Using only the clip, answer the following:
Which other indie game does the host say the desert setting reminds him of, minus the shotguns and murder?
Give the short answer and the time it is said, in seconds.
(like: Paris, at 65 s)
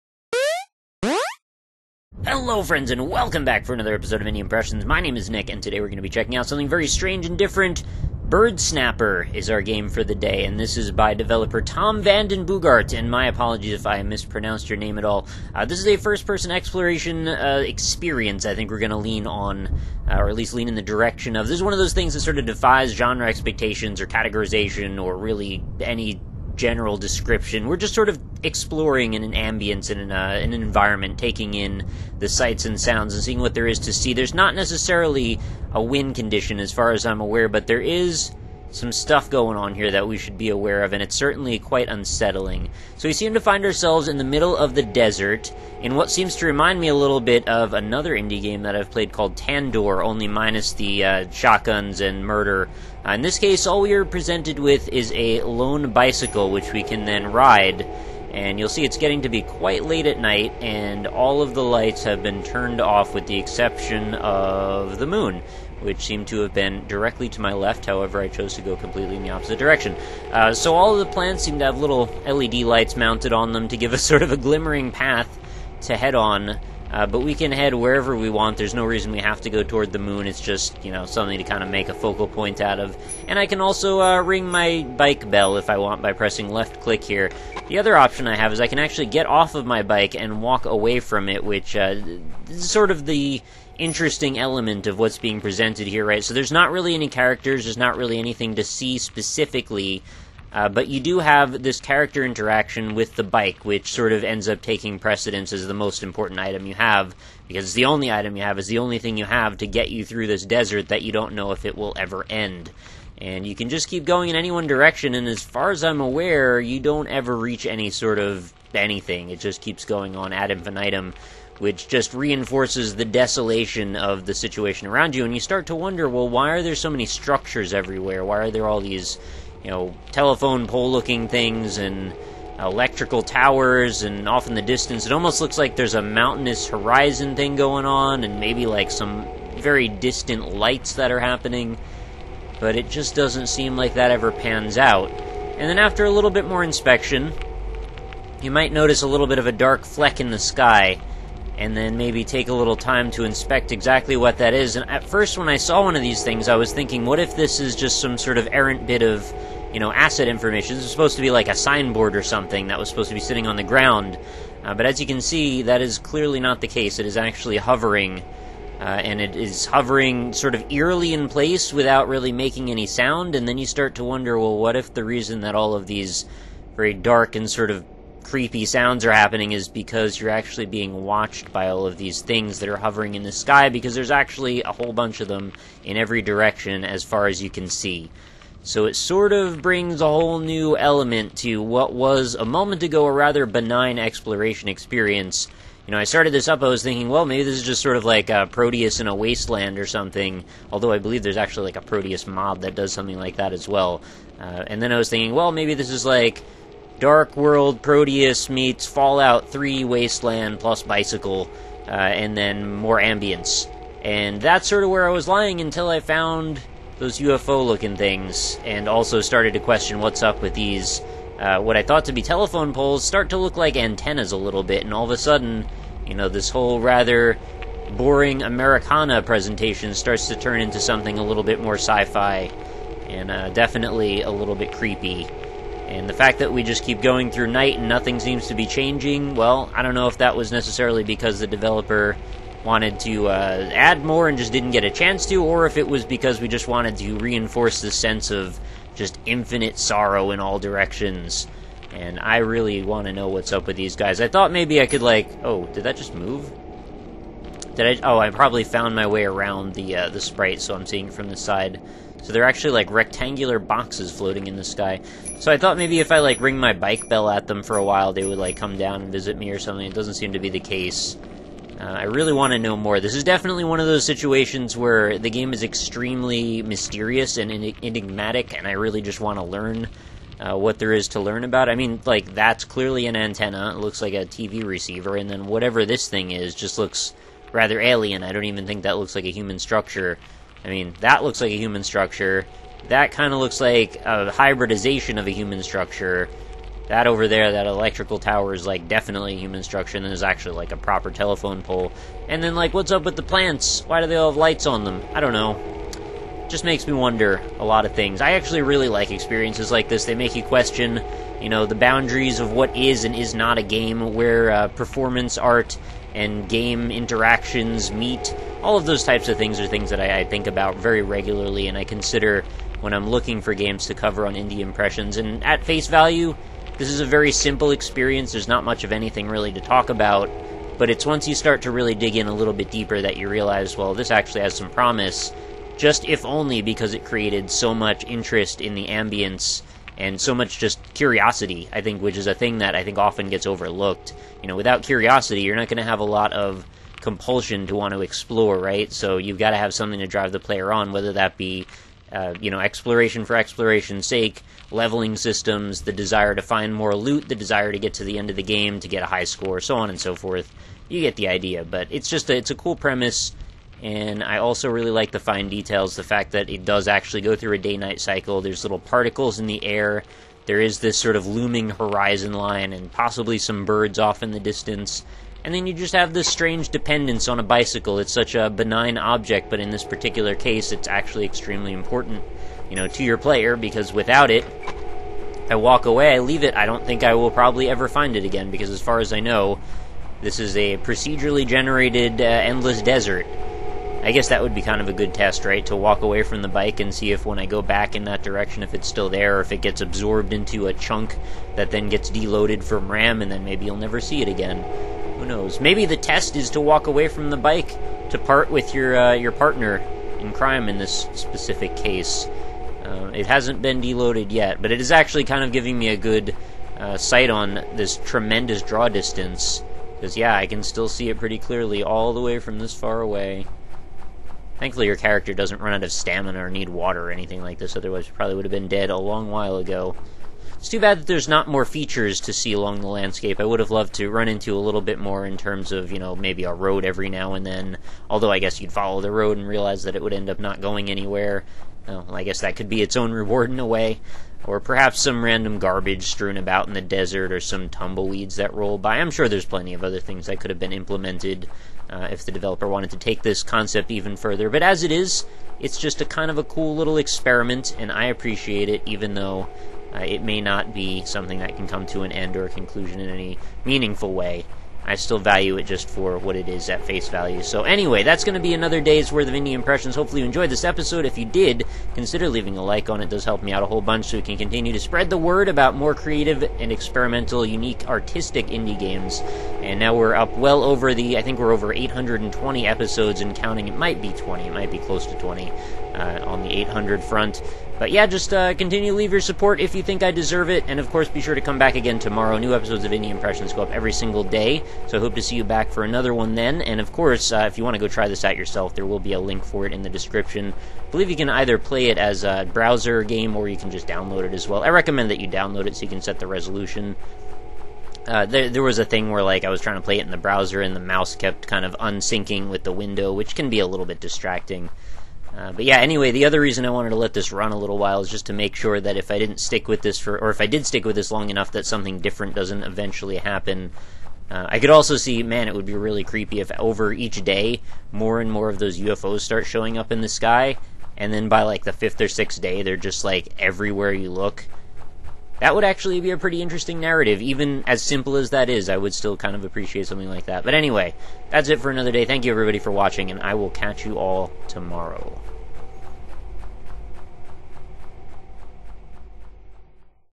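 Tandor, at 49 s.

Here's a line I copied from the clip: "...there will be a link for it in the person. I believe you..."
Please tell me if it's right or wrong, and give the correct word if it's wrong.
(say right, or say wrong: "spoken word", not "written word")
wrong: "description", not "person".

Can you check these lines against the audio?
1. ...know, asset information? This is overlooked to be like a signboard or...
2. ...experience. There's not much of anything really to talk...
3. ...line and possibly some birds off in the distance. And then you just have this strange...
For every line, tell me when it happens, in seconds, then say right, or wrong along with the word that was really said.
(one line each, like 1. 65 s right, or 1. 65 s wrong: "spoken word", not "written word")
1. 159 s wrong: "supposed", not "overlooked"
2. 327 s right
3. 372 s right.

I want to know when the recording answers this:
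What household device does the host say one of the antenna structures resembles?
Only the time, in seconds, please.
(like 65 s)
284 s.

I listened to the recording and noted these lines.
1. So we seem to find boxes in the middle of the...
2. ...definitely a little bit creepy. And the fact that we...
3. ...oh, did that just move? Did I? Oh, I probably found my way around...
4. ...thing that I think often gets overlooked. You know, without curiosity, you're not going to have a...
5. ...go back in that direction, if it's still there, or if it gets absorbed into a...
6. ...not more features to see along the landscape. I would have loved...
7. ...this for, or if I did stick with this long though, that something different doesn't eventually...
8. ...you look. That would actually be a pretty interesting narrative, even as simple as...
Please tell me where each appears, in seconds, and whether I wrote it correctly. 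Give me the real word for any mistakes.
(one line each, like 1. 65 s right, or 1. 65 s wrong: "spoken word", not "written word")
1. 42 s wrong: "ourselves", not "boxes"
2. 233 s right
3. 255 s right
4. 342 s right
5. 397 s right
6. 431 s right
7. 519 s wrong: "enough", not "though"
8. 533 s right.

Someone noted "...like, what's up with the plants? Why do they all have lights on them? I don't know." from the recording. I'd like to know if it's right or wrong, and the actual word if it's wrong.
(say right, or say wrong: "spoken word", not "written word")
right.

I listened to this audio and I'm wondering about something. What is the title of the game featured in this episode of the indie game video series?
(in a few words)
Bird Snapper.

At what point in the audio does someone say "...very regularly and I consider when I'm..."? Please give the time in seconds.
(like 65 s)
320 s.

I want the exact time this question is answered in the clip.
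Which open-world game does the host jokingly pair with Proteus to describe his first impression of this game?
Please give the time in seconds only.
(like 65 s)
208 s.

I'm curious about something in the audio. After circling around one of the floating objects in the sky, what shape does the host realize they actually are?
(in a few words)
Rectangular boxes.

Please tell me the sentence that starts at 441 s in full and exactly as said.
Well, I guess that could be its own reward in a way.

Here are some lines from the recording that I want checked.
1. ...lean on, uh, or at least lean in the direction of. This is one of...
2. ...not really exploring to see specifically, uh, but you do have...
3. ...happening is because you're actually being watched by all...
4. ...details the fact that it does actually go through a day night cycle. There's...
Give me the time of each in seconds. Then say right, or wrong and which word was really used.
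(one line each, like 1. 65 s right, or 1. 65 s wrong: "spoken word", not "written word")
1. 18 s right
2. 97 s wrong: "anything", not "exploring"
3. 179 s right
4. 365 s right.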